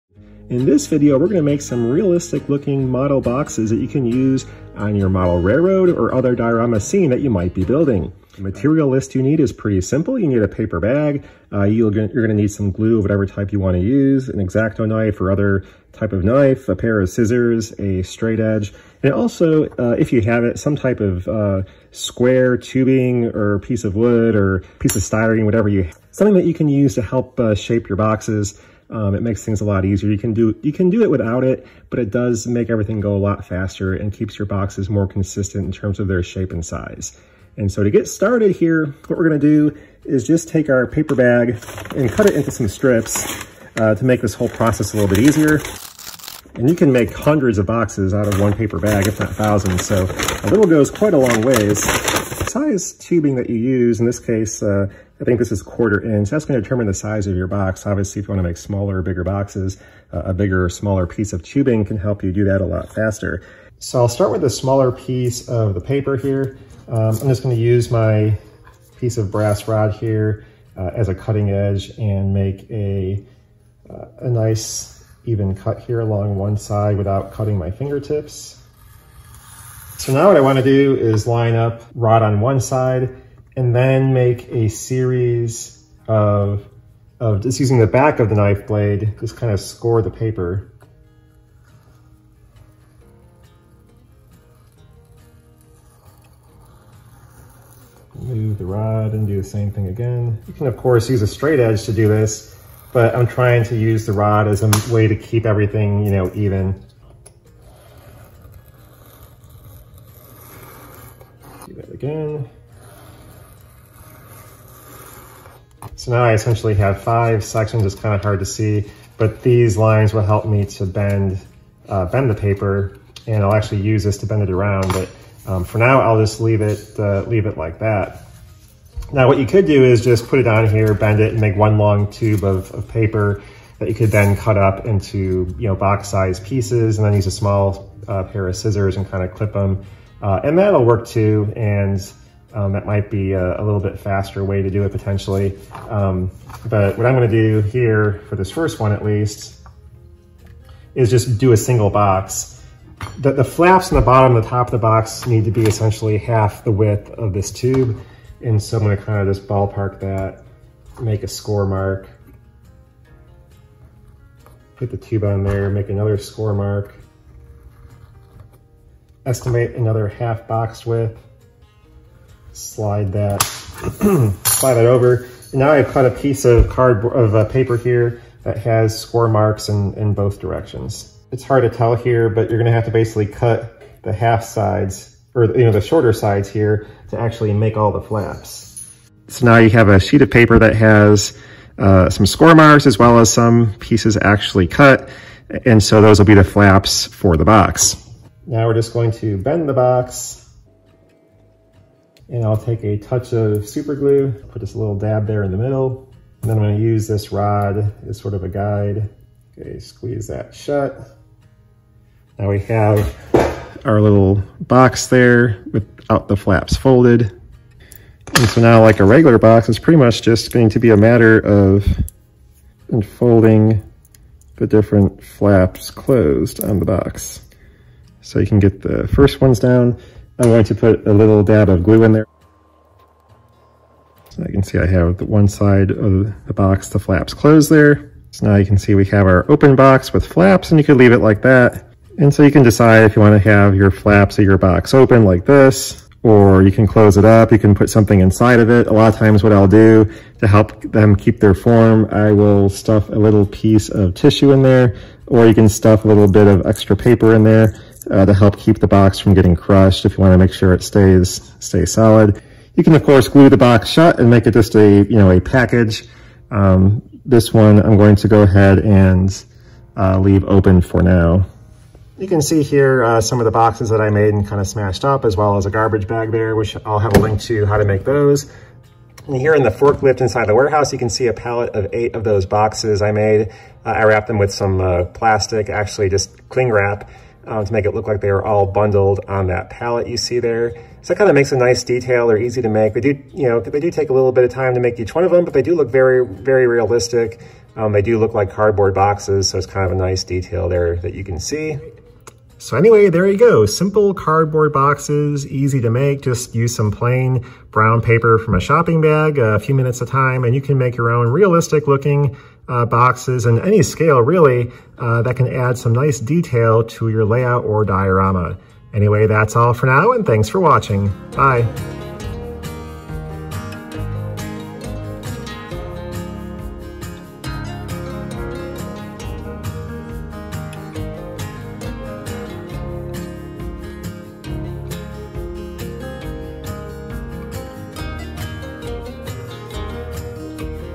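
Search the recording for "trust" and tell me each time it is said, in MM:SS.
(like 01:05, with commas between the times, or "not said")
not said.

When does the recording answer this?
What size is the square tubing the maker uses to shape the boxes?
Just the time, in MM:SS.
00:55.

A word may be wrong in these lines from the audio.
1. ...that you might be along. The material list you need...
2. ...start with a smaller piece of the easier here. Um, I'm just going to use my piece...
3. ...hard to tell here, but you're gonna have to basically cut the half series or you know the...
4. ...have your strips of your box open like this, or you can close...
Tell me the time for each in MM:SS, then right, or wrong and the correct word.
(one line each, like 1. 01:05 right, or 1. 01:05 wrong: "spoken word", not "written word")
1. 00:07 wrong: "building", not "along"
2. 01:04 wrong: "paper", not "easier"
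3. 03:01 wrong: "sides", not "series"
4. 04:03 wrong: "flaps", not "strips".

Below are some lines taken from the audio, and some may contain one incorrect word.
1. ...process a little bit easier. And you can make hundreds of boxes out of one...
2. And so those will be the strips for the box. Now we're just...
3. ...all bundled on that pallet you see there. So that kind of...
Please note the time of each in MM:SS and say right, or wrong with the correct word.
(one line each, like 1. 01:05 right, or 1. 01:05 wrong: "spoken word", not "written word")
1. 00:44 right
2. 03:15 wrong: "flaps", not "strips"
3. 04:48 right.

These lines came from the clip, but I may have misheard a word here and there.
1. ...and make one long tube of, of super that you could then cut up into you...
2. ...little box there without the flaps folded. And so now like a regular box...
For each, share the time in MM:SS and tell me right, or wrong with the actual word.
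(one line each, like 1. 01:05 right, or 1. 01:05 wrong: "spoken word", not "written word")
1. 02:11 wrong: "paper", not "super"
2. 03:34 right.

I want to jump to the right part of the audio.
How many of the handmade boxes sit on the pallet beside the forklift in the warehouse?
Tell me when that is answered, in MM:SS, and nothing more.
04:41.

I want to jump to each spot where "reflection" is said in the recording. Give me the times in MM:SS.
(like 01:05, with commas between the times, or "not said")
not said.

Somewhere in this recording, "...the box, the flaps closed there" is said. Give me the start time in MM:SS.
03:56.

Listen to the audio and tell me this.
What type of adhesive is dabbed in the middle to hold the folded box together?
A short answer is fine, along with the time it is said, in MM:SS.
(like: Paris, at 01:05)
Super glue, at 03:23.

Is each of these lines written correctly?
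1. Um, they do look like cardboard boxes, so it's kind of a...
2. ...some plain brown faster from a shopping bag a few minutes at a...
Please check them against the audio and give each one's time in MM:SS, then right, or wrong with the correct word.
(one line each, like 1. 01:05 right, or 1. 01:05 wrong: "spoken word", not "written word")
1. 04:57 right
2. 05:06 wrong: "paper", not "faster".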